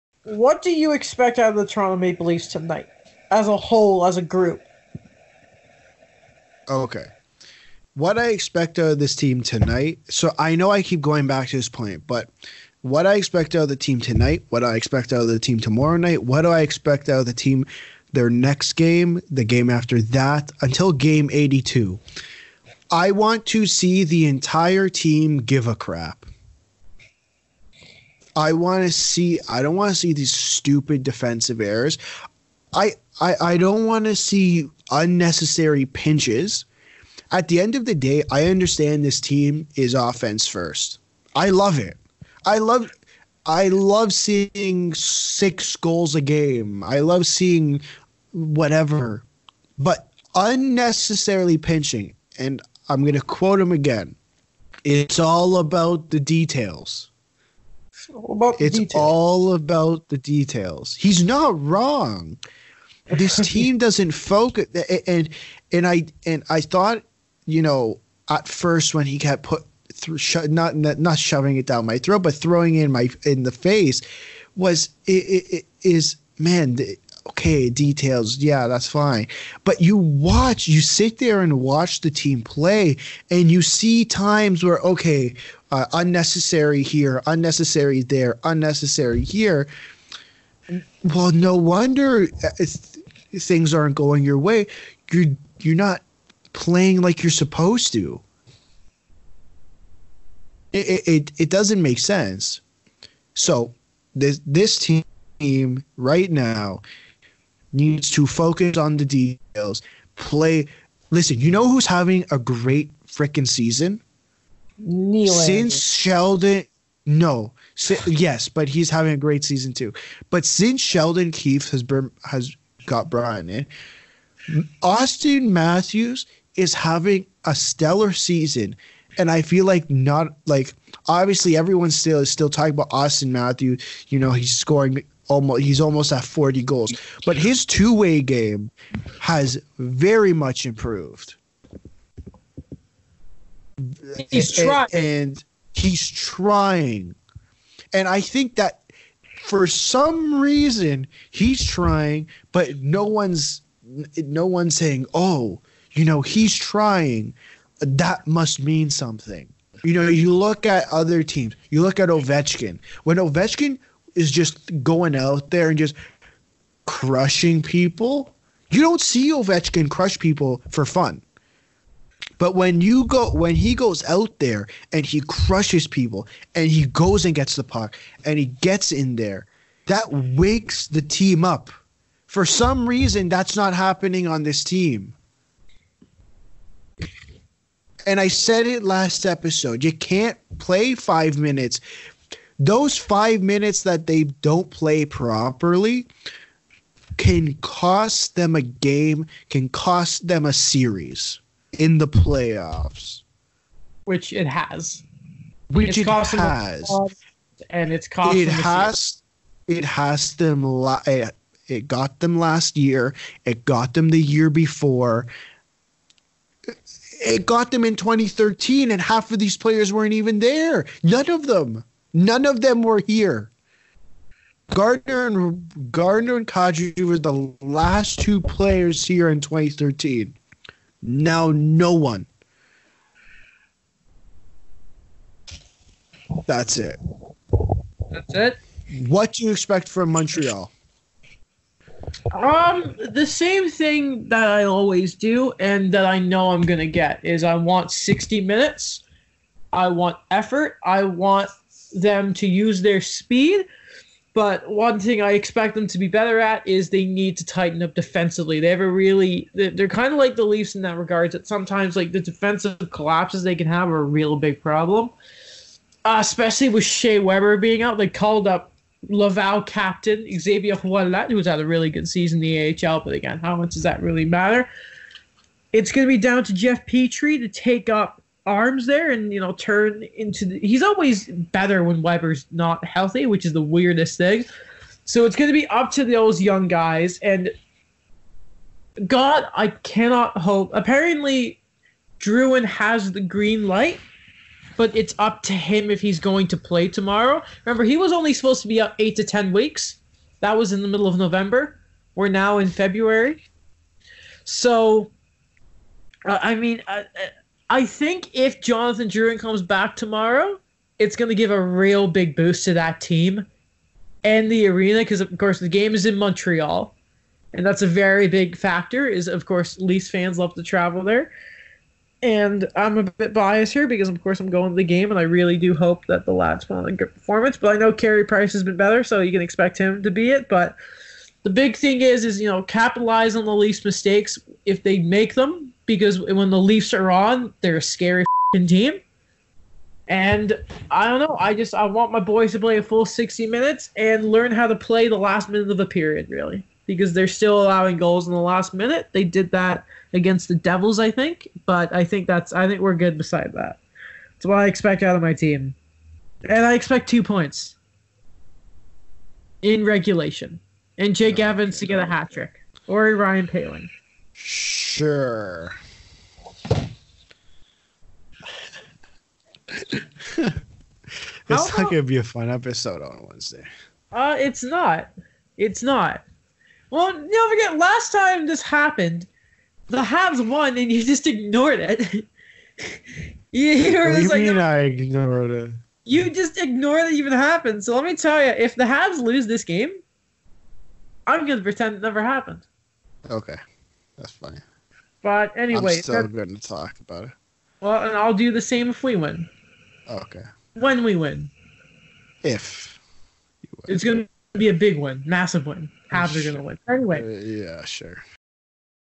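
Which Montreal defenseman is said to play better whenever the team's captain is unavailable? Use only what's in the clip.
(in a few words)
Jeff Petry.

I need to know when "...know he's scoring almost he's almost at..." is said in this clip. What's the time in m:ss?
2:14.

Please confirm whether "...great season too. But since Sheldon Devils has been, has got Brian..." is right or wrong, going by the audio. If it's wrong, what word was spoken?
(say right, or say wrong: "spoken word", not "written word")
wrong: "Keefe", not "Devils".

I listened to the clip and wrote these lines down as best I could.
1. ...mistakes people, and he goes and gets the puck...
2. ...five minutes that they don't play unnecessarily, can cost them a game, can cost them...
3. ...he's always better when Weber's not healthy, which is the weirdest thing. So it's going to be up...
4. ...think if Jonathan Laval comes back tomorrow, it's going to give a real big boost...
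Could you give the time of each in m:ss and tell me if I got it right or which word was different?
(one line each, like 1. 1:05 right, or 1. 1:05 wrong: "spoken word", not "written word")
1. 2:55 wrong: "crushes", not "mistakes"
2. 3:12 wrong: "properly", not "unnecessarily"
3. 4:40 right
4. 5:07 wrong: "Drouin", not "Laval".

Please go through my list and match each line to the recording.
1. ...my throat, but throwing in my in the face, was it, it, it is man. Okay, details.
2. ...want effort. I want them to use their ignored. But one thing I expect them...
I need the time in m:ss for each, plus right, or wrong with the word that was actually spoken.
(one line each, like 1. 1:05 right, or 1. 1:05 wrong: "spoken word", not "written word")
1. 1:11 right
2. 4:09 wrong: "speed", not "ignored".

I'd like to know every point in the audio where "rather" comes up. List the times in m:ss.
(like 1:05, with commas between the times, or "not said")
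not said.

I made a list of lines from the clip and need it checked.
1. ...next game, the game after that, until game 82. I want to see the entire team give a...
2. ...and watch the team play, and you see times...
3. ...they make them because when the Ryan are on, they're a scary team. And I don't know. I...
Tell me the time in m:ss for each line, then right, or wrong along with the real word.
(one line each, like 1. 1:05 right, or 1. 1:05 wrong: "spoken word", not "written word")
1. 0:18 right
2. 1:21 right
3. 5:34 wrong: "Leafs", not "Ryan".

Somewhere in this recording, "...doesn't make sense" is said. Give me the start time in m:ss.
1:41.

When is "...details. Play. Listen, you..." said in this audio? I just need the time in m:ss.
1:49.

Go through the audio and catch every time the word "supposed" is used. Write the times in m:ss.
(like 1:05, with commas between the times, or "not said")
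1:37, 4:58.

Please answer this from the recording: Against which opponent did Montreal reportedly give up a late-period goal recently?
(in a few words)
Devils.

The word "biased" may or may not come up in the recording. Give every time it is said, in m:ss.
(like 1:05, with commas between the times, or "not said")
5:23.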